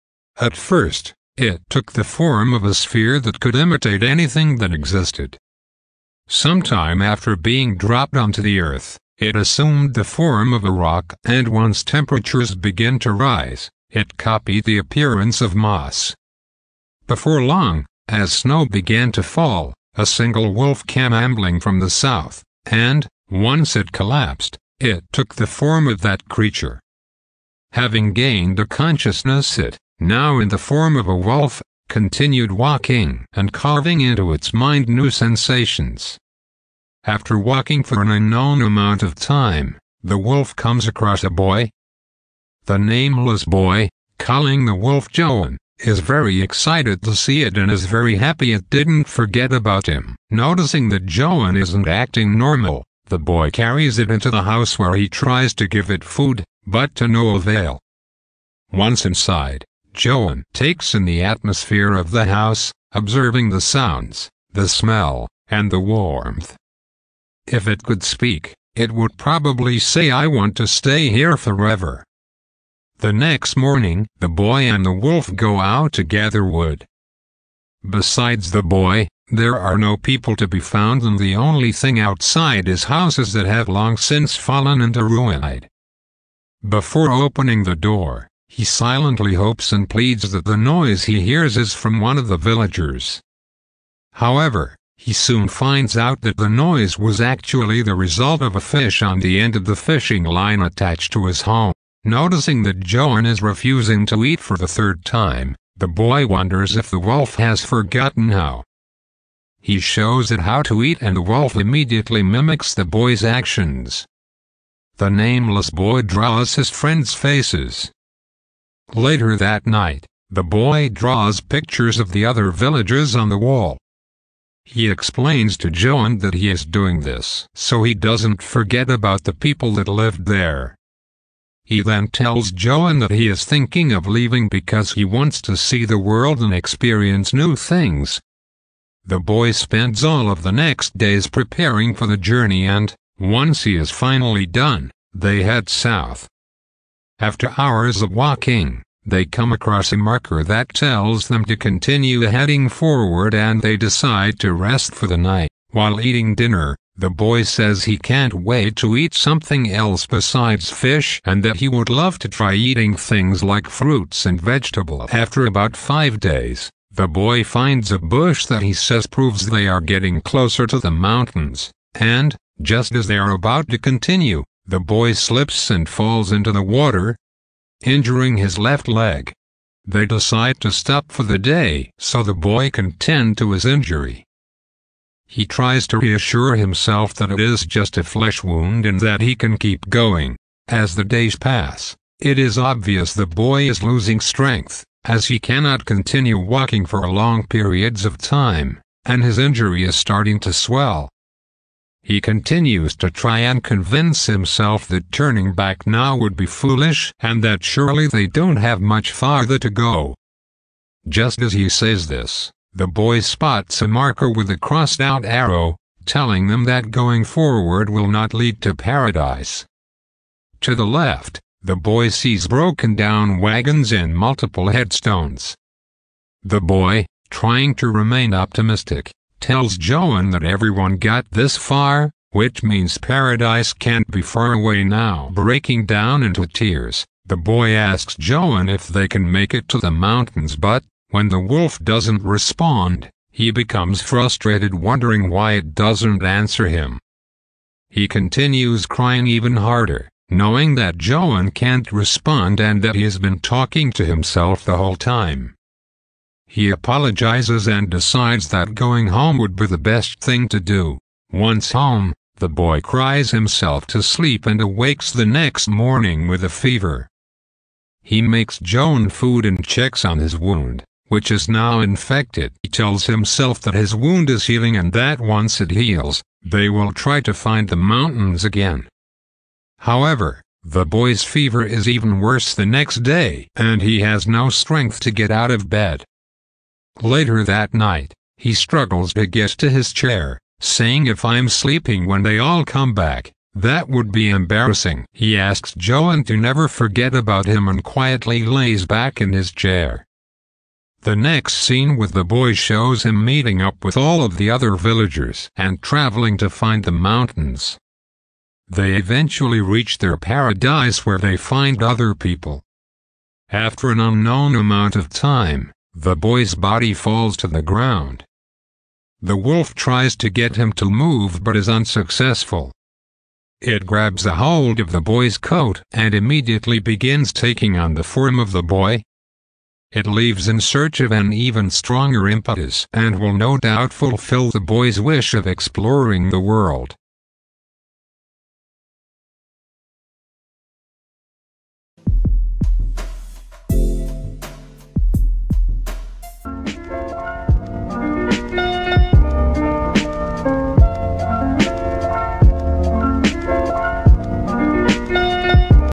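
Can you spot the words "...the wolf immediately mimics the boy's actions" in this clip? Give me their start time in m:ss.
1:51.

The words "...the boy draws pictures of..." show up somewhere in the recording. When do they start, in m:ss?
2:00.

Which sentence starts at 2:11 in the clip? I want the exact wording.
He then tells Joaan that he is thinking of leaving because he wants to see the world and experience new things.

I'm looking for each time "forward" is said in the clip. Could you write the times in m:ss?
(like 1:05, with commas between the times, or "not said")
2:32, 3:37.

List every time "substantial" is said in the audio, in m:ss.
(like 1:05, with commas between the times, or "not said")
not said.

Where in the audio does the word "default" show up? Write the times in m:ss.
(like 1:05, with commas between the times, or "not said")
not said.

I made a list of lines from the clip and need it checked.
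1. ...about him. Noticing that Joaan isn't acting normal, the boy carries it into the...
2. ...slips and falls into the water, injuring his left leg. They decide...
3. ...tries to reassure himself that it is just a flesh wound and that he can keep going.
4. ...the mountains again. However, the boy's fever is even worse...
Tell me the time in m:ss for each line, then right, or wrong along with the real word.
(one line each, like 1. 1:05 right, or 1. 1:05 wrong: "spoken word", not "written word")
1. 0:49 right
2. 2:55 right
3. 3:05 right
4. 4:37 right.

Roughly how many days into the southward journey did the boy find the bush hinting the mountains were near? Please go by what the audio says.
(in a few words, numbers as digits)
5.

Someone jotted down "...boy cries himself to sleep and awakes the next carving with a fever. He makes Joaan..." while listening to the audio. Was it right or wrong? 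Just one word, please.
wrong.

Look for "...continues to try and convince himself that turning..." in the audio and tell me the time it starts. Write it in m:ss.
3:22.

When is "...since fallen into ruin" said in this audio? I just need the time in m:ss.
1:23.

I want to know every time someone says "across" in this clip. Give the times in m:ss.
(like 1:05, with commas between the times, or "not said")
0:40, 2:29.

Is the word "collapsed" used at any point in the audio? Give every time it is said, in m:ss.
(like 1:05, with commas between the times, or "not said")
0:23.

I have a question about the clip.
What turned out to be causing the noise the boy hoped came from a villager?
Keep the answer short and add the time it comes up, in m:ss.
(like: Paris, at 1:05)
A fish, at 1:38.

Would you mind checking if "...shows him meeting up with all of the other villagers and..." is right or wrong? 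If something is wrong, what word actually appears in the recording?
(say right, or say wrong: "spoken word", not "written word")
right.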